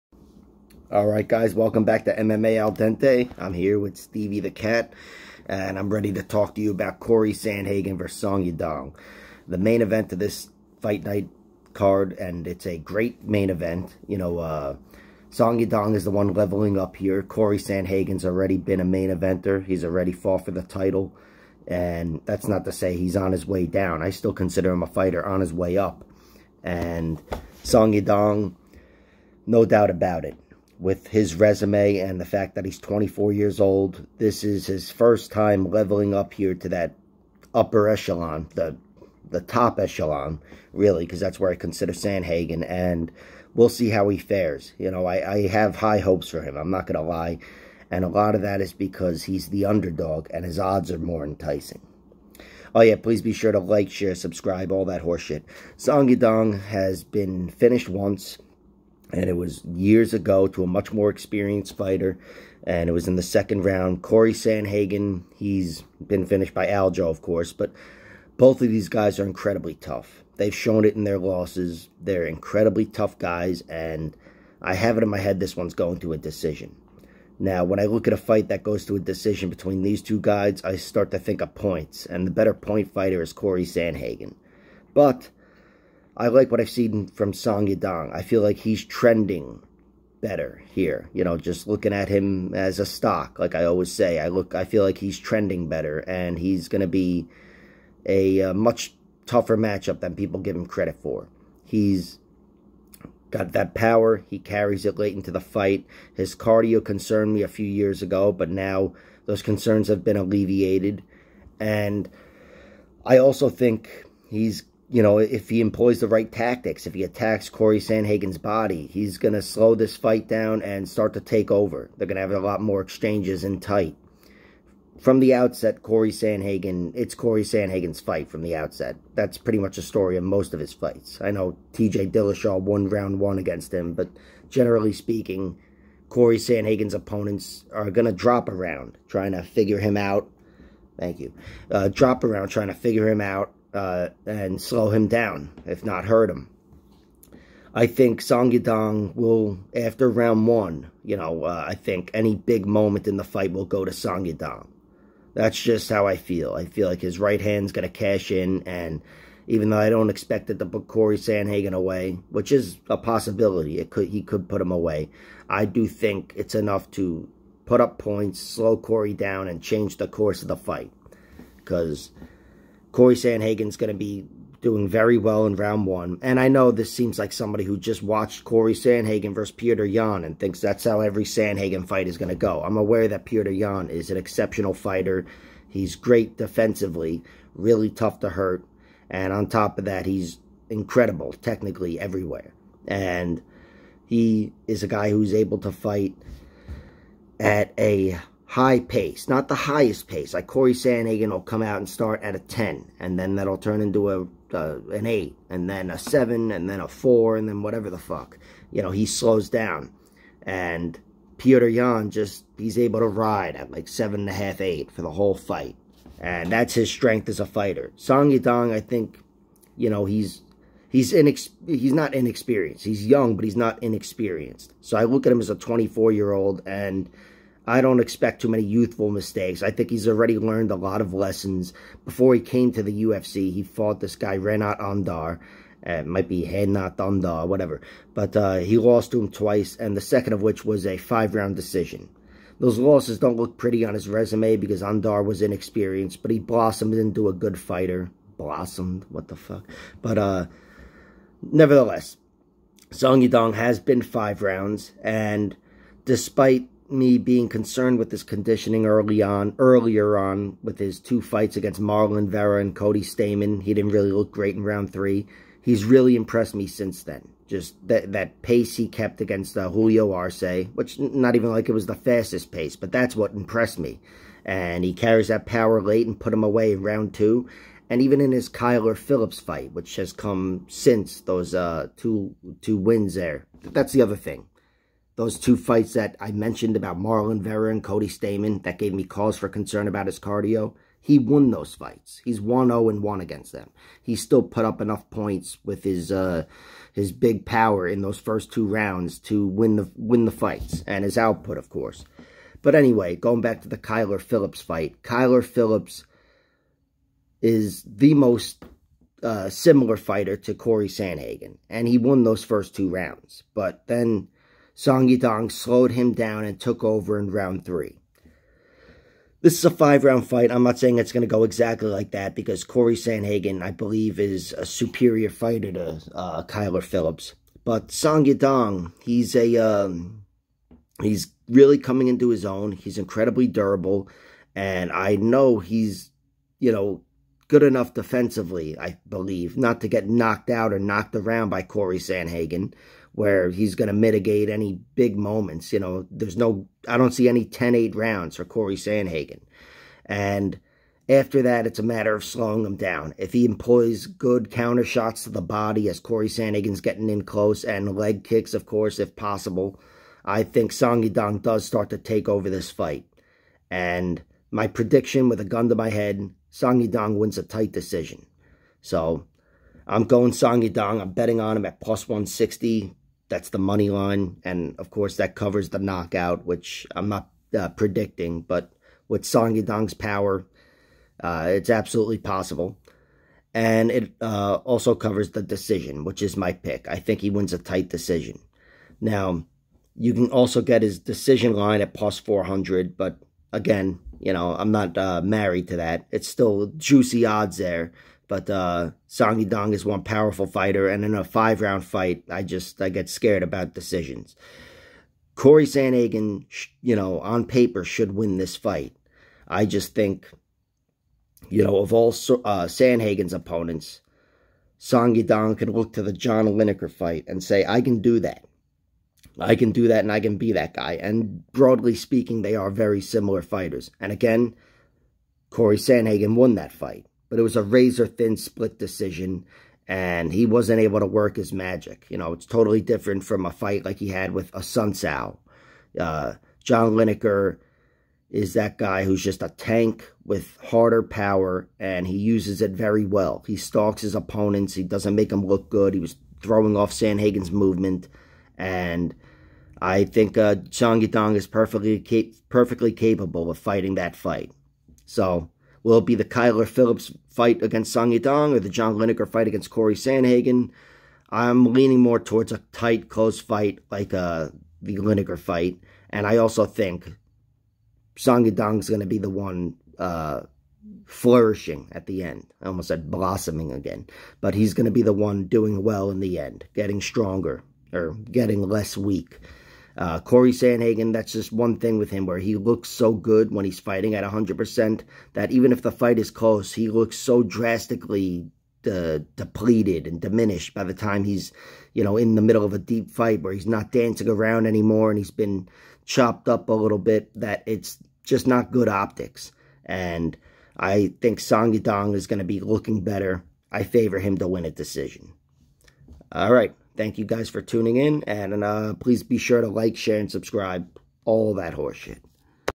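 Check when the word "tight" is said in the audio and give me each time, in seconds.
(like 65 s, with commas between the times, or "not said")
123 s, 367 s, 387 s, 462 s.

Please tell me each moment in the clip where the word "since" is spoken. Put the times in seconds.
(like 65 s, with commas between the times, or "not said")
266 s, 280 s.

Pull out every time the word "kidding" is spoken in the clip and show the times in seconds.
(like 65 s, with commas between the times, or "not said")
not said.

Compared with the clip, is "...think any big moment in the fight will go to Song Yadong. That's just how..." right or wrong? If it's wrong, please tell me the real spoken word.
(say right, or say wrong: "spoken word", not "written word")
right.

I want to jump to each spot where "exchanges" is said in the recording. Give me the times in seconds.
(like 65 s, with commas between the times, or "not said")
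122 s.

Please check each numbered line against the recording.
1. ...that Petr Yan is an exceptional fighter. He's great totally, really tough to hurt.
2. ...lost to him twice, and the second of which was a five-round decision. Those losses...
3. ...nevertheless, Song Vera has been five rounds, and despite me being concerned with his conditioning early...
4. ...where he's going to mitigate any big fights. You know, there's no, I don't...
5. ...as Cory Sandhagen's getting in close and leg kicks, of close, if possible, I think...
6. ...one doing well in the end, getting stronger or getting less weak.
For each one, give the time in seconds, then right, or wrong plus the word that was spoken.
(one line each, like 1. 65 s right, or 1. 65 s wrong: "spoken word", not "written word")
1. 183 s wrong: "defensively", not "totally"
2. 238 s right
3. 251 s wrong: "Yadong", not "Vera"
4. 343 s wrong: "moments", not "fights"
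5. 355 s wrong: "course", not "close"
6. 475 s right.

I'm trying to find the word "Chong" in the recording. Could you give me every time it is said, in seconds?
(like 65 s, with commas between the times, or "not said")
450 s.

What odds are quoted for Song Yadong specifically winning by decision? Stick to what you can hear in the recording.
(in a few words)
+400.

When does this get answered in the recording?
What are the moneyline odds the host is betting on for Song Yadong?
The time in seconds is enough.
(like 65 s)
371 s.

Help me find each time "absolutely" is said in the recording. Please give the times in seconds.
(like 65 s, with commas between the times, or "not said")
381 s.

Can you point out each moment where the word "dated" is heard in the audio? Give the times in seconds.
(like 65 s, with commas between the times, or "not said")
not said.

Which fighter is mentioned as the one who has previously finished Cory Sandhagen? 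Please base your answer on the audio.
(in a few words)
Aljo.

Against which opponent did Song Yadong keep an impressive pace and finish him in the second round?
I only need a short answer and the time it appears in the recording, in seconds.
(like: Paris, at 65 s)
Julio Arce, at 269 s.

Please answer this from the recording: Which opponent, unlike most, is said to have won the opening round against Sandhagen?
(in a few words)
TJ Dillashaw.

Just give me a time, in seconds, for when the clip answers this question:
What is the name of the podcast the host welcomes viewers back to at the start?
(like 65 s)
2 s.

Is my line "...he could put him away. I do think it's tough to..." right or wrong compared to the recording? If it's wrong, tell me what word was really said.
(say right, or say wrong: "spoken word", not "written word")
wrong: "enough", not "tough".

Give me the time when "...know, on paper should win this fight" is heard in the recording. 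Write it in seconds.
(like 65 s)
406 s.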